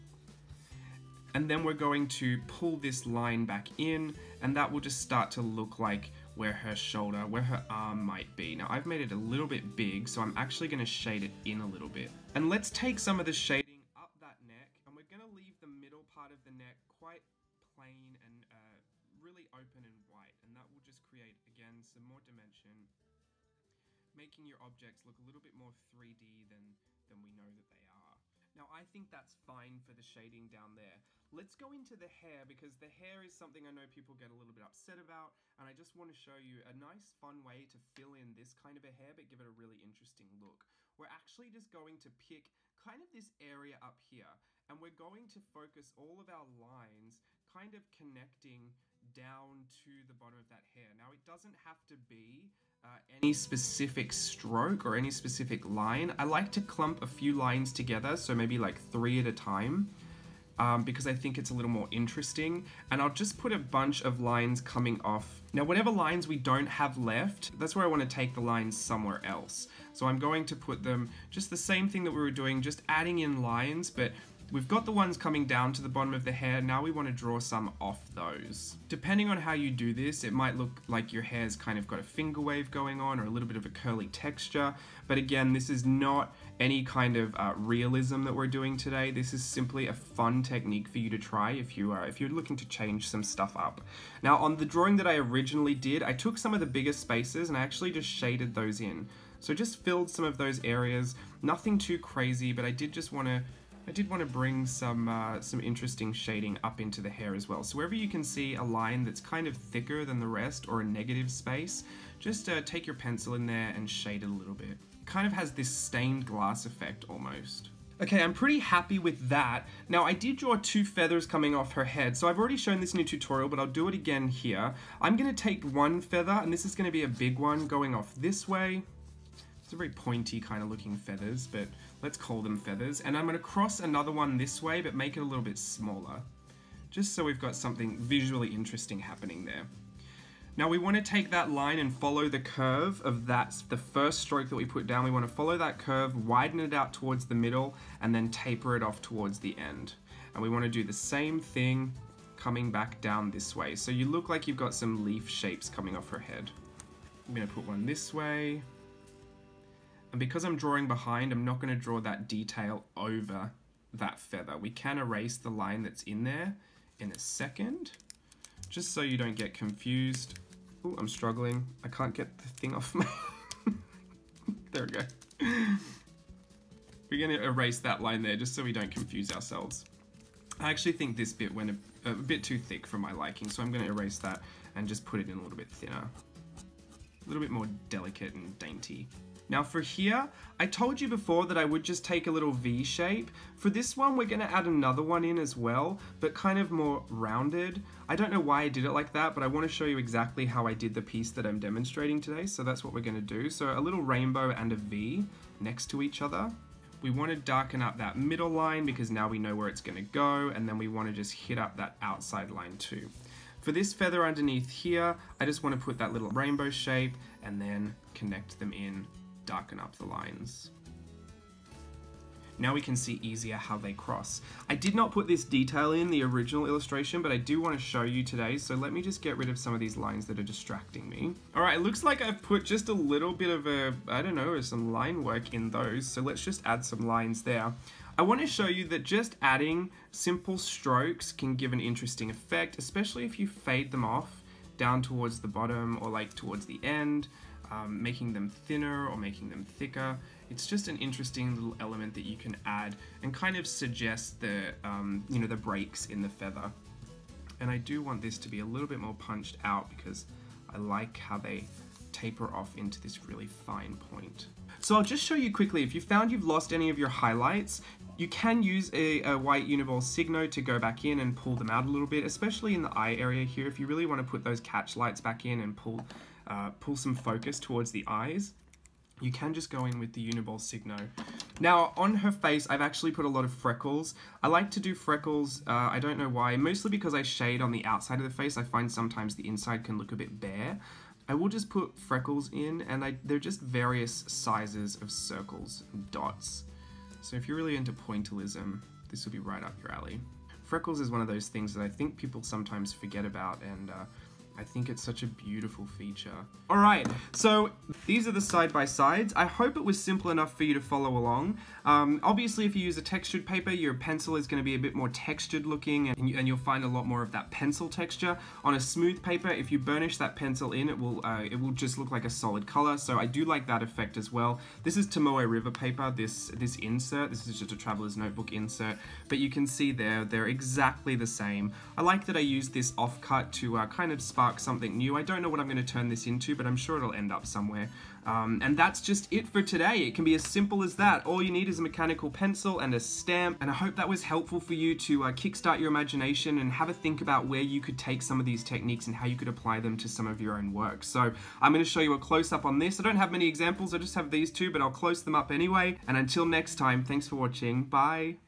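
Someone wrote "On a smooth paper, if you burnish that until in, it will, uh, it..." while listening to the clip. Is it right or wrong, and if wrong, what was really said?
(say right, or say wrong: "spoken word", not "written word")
wrong: "pencil", not "until".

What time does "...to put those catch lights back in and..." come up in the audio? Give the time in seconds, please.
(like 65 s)
274 s.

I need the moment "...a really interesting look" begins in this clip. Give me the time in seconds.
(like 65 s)
39 s.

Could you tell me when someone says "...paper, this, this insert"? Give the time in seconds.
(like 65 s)
325 s.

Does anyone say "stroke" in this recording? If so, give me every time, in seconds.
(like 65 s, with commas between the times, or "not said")
54 s, 144 s, 240 s.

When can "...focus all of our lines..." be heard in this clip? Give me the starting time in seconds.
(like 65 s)
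45 s.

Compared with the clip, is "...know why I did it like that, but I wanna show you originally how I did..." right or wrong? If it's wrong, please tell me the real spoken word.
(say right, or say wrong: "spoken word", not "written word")
wrong: "exactly", not "originally".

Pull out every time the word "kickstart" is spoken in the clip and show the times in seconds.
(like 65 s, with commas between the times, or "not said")
345 s.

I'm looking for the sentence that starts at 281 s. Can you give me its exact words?
Now, on her face, I've actually put a lot of freckles.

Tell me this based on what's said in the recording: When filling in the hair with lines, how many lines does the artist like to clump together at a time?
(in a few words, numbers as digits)
3.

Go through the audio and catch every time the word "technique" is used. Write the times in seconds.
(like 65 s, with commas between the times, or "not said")
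90 s, 348 s.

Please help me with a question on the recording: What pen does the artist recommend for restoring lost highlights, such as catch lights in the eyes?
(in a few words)
white Uniball Signo.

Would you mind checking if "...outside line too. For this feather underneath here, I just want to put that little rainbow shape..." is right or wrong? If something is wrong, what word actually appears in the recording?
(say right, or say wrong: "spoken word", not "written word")
right.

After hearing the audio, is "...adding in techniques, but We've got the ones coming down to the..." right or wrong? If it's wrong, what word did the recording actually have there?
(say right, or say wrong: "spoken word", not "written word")
wrong: "lines", not "techniques".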